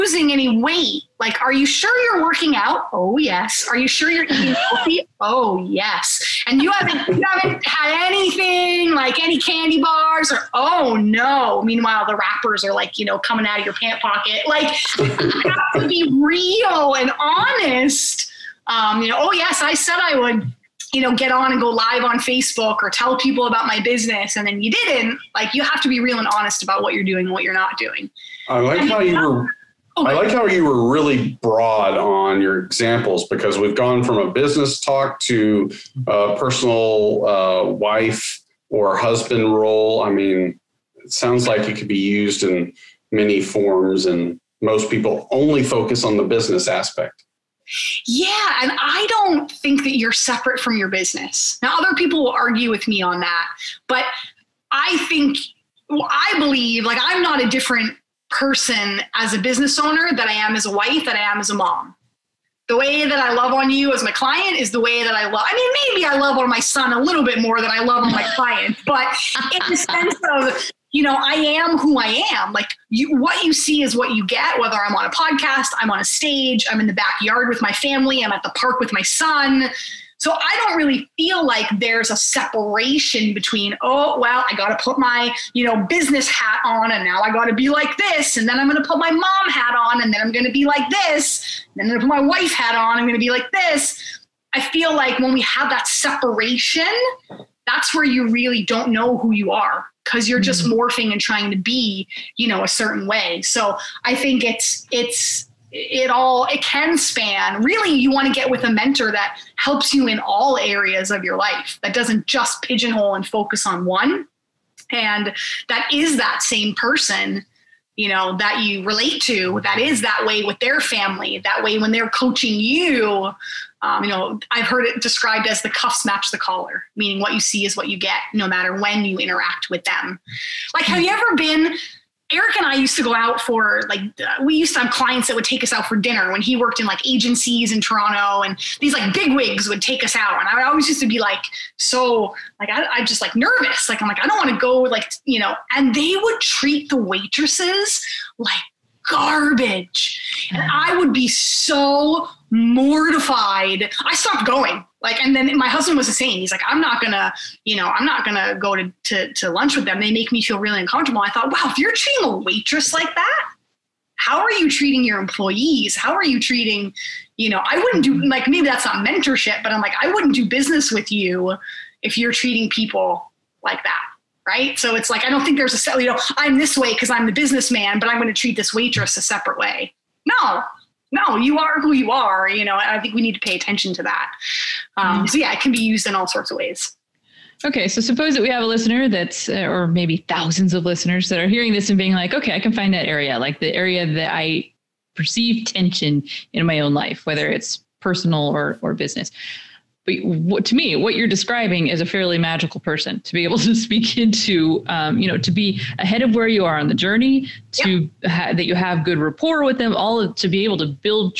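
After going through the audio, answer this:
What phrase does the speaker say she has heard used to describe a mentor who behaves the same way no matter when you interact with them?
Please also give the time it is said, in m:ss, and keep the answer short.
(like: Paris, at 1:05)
the cuffs match the collar, at 2:05.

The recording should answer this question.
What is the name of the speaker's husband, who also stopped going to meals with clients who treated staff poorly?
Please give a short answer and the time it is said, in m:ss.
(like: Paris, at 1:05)
Eric, at 2:12.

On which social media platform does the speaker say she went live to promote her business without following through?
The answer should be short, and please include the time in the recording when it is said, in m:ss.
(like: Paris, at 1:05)
Facebook, at 0:22.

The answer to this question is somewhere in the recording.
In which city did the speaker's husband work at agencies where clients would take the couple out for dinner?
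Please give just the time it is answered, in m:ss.
2:17.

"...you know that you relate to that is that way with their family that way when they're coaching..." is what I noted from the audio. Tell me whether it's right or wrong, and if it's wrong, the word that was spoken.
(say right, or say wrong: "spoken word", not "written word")
right.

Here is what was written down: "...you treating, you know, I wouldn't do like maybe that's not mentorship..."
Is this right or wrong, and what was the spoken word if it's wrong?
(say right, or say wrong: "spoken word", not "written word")
right.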